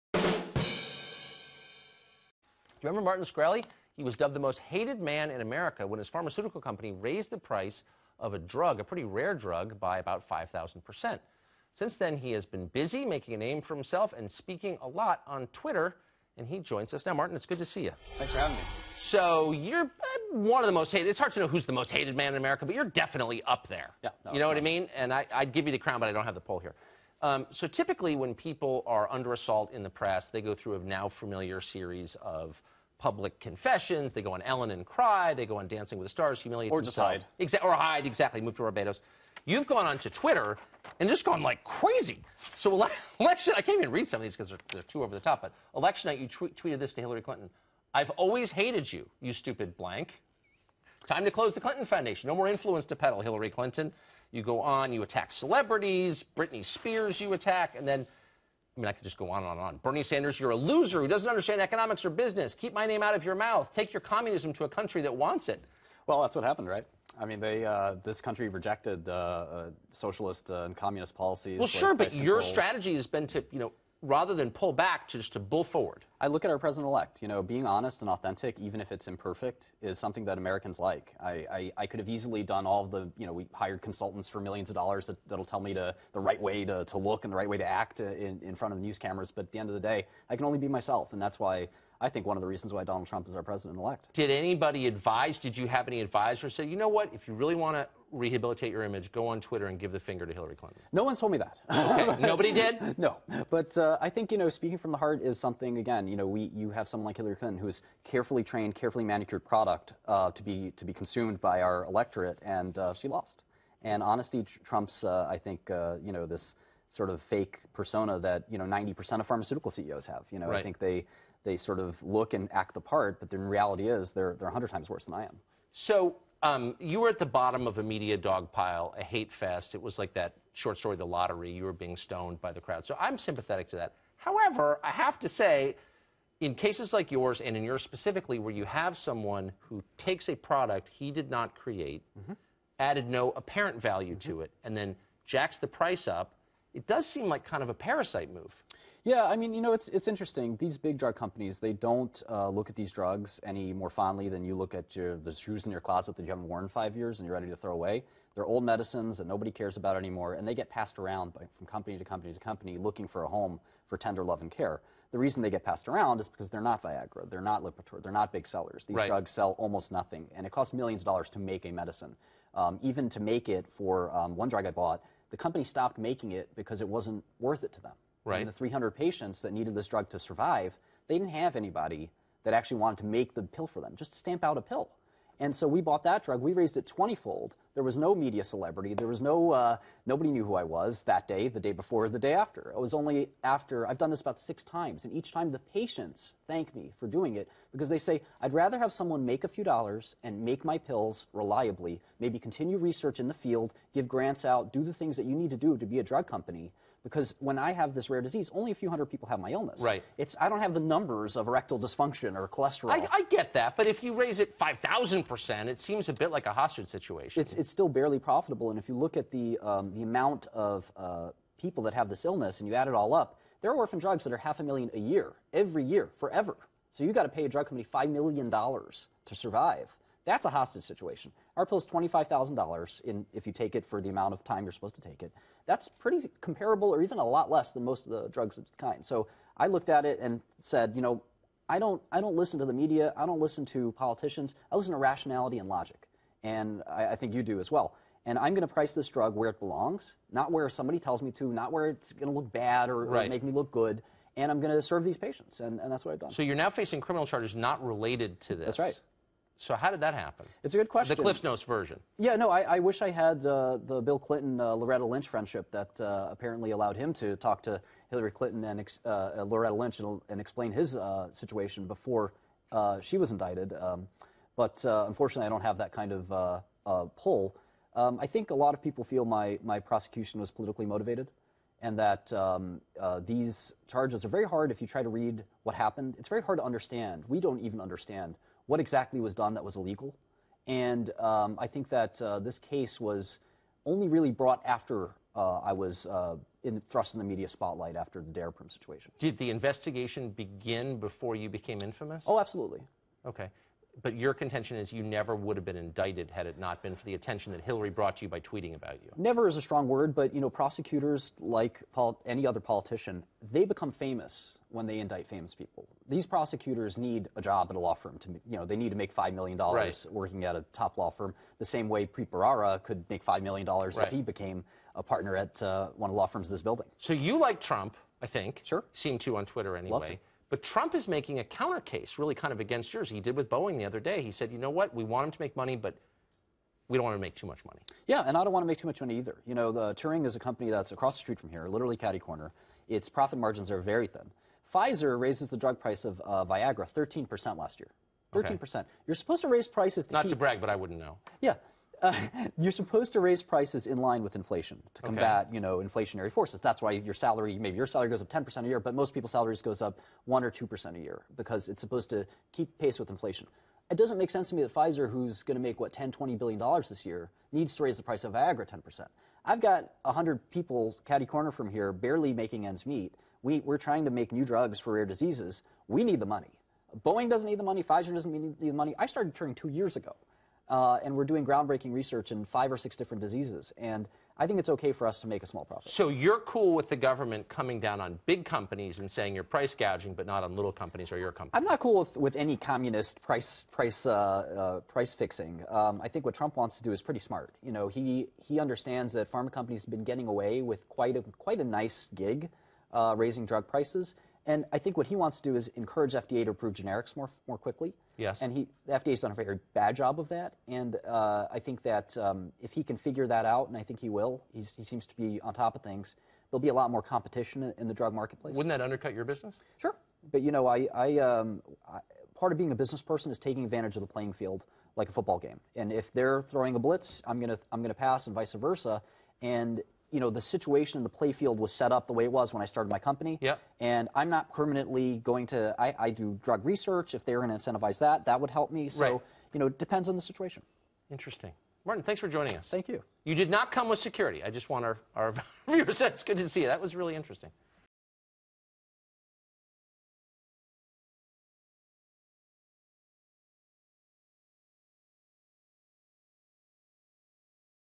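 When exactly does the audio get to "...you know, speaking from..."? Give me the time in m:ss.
1:44.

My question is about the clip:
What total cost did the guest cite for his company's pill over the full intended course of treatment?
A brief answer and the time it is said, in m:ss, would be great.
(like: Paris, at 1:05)
$25,000, at 3:51.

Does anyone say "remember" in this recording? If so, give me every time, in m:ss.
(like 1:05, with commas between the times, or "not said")
0:02.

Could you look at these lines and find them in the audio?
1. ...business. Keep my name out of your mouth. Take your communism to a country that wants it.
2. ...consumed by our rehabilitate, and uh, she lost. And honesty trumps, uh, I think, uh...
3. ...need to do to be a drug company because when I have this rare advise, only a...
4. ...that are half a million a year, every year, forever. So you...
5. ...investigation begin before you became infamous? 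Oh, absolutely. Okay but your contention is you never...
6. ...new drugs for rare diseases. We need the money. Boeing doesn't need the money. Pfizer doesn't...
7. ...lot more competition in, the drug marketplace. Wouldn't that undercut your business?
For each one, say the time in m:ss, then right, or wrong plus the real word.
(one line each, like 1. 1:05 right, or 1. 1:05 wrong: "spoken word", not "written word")
1. 1:02 right
2. 1:50 wrong: "electorate", not "rehabilitate"
3. 3:25 wrong: "disease", not "advise"
4. 3:44 right
5. 4:59 right
6. 6:14 right
7. 6:56 right.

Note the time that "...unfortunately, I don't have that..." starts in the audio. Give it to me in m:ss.
4:34.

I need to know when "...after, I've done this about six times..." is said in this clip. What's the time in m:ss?
3:13.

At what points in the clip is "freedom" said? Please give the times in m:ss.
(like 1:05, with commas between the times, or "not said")
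not said.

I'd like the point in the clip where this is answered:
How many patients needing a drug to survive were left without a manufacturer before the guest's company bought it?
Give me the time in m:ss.
2:58.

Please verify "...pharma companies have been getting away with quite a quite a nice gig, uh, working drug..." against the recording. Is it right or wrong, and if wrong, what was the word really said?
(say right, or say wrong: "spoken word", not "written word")
wrong: "raising", not "working".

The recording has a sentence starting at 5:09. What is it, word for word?
Never is a strong word, but you know, prosecutors, like any other politician, they become famous when they indict famous people.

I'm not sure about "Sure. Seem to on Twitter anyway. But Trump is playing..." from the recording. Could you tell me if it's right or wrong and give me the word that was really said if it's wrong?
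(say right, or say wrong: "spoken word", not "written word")
wrong: "making", not "playing".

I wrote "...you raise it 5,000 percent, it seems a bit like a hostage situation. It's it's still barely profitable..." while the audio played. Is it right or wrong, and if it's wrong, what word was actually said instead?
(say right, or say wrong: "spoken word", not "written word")
right.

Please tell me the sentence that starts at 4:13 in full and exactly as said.
or make me look good and I'm going to serve these patients, and, and that's what I've done.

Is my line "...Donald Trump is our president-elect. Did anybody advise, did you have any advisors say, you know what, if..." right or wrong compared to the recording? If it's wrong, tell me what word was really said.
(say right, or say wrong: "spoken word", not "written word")
right.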